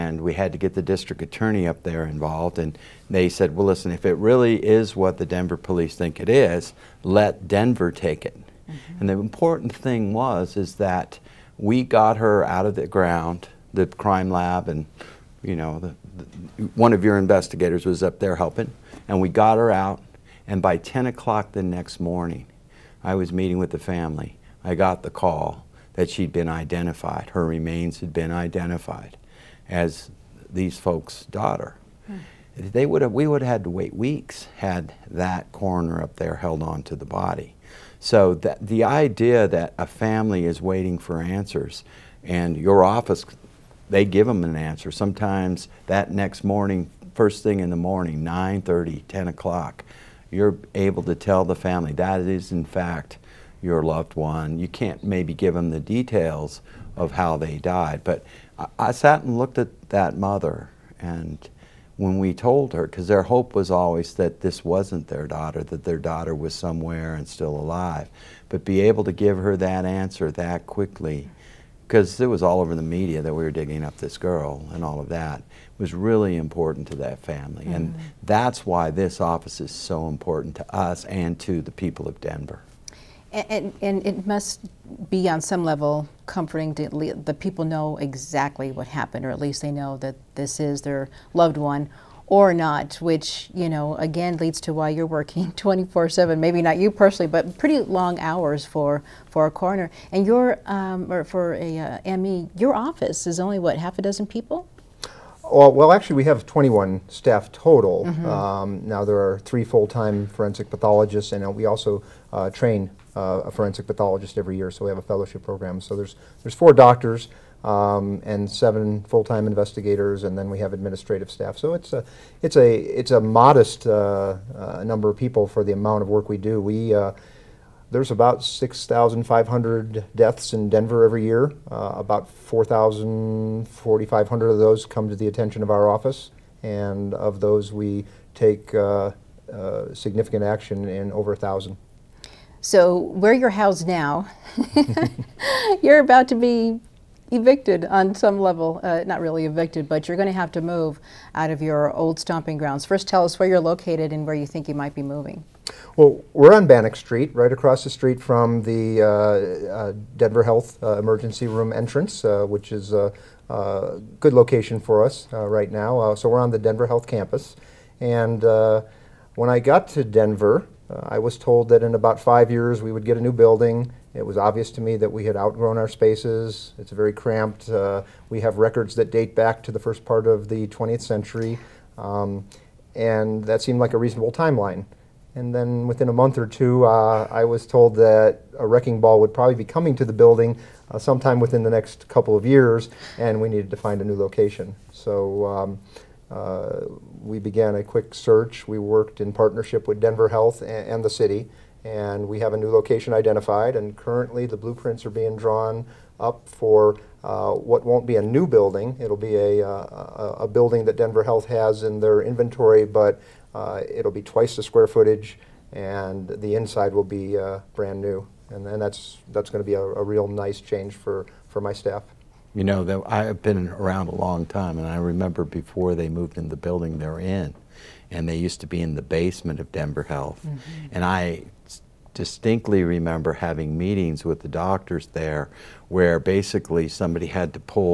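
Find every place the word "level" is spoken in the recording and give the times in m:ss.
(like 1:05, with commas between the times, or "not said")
1:25, 2:28.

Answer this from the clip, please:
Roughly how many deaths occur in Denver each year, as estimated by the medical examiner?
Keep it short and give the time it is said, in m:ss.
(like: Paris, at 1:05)
6,500, at 2:08.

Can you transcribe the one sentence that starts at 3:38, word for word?
And, then that's that's going to be a, a real nice change for, for my staff.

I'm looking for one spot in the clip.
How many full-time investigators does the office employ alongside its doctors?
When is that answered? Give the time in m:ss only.
1:58.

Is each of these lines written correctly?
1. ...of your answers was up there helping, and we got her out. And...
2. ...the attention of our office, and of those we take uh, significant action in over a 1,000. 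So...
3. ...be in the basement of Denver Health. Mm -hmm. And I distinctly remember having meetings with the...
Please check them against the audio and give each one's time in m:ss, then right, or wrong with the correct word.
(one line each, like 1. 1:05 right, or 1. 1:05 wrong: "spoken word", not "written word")
1. 0:16 wrong: "investigators", not "answers"
2. 2:15 right
3. 3:48 right.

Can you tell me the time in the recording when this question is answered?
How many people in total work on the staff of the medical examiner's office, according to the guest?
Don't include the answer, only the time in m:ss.
1:46.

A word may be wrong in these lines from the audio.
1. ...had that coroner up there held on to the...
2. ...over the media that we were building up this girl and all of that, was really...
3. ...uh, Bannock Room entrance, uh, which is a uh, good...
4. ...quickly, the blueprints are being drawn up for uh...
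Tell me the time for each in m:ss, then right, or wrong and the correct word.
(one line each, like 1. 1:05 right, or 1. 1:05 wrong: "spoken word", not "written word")
1. 0:34 right
2. 1:12 wrong: "digging", not "building"
3. 2:40 wrong: "Emergency", not "Bannock"
4. 3:23 wrong: "currently", not "quickly".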